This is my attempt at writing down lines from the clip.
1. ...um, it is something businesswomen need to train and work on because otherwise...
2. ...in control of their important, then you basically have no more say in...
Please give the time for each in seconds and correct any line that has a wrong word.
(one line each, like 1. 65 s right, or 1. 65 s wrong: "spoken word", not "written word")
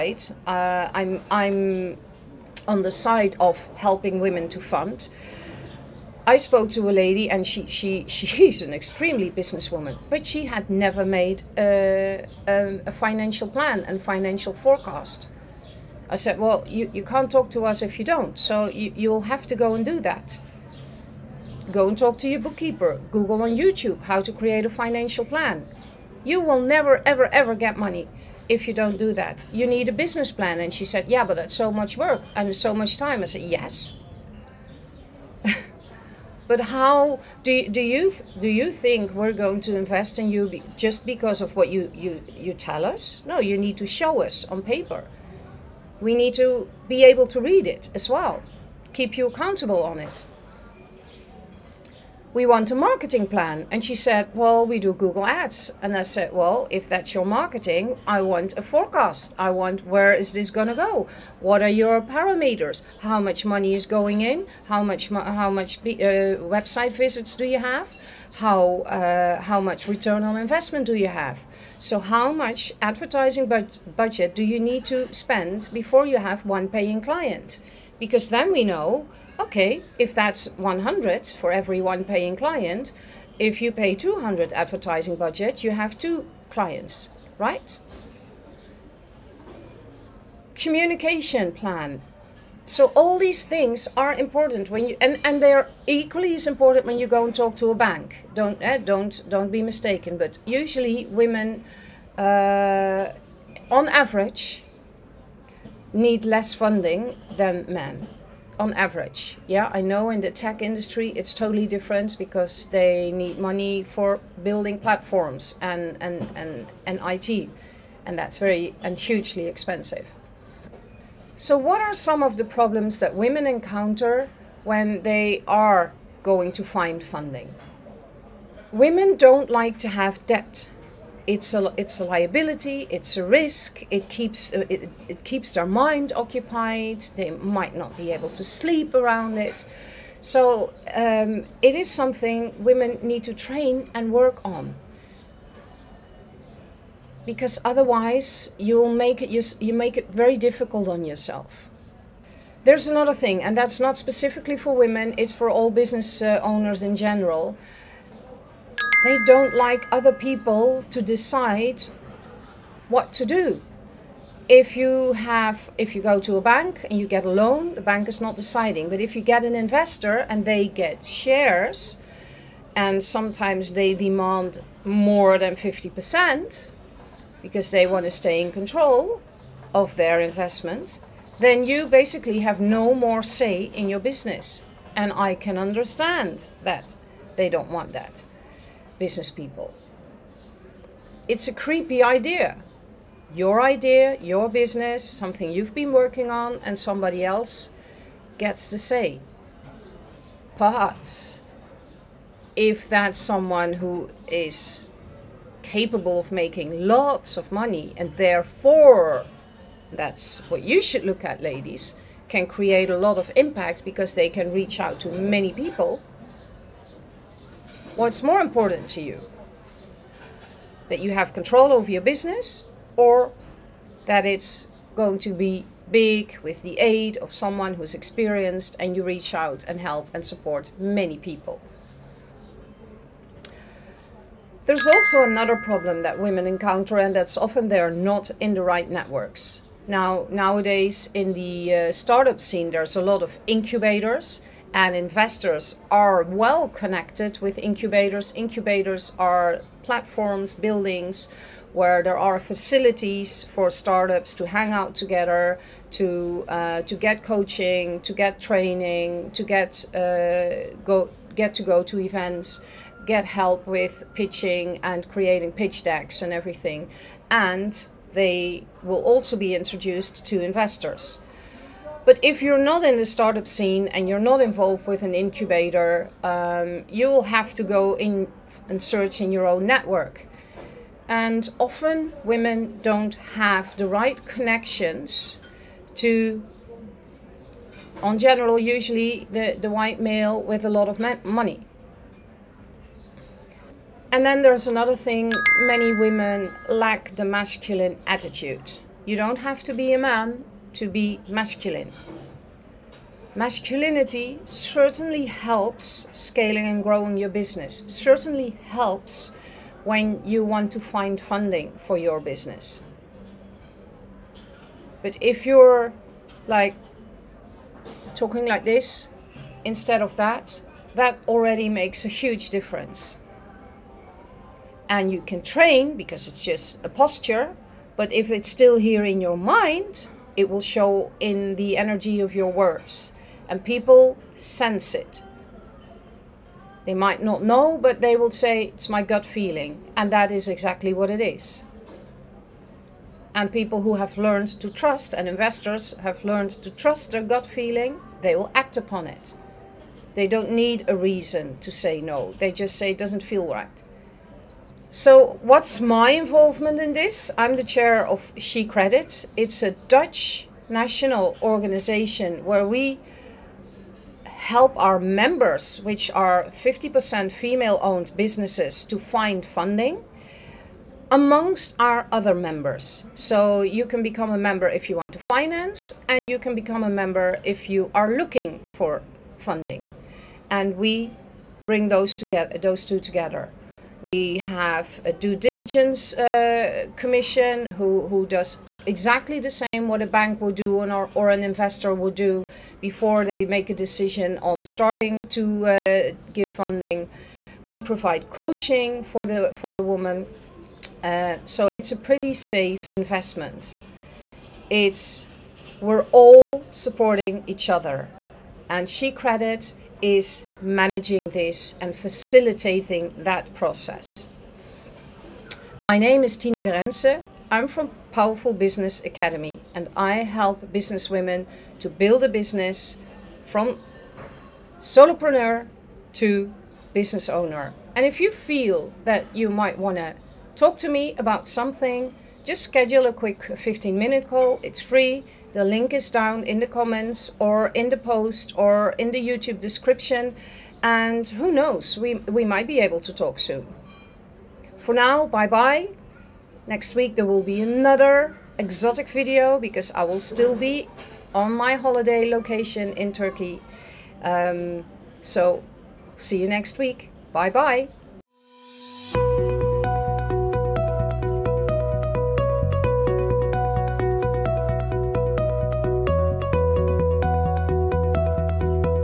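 1. 140 s wrong: "women", not "businesswomen"
2. 178 s wrong: "investment", not "important".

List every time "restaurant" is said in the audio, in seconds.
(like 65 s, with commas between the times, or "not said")
not said.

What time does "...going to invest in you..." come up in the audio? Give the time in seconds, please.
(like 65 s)
39 s.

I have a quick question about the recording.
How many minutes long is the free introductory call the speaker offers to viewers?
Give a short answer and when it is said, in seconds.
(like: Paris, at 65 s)
15, at 433 s.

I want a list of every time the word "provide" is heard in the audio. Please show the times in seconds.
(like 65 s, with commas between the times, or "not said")
397 s.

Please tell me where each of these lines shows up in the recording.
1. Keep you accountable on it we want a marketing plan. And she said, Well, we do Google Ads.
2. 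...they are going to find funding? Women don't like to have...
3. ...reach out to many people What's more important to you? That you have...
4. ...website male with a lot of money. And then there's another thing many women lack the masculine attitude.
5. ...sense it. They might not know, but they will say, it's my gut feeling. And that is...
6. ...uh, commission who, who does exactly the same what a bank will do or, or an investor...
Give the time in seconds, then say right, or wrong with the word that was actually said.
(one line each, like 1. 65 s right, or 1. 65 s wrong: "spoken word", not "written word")
1. 48 s right
2. 125 s right
3. 214 s right
4. 289 s wrong: "white", not "website"
5. 334 s right
6. 386 s right.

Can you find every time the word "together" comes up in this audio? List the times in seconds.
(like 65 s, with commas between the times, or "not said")
254 s, 382 s.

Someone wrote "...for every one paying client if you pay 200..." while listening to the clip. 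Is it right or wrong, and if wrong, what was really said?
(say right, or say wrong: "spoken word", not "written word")
right.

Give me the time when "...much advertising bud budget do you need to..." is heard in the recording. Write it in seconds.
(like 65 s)
72 s.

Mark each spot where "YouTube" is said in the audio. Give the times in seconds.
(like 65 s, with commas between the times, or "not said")
23 s, 439 s.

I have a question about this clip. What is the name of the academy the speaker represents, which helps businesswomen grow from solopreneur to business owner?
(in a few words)
Powerful Business Academy.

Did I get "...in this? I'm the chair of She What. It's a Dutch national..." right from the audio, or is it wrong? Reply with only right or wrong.
wrong.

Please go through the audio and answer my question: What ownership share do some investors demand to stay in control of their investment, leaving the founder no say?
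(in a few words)
more than 50%.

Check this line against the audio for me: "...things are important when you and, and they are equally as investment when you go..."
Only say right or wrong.
wrong.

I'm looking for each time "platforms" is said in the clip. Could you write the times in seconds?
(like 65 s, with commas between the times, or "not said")
114 s, 249 s.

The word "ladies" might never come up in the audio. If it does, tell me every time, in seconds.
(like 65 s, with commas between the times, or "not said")
211 s.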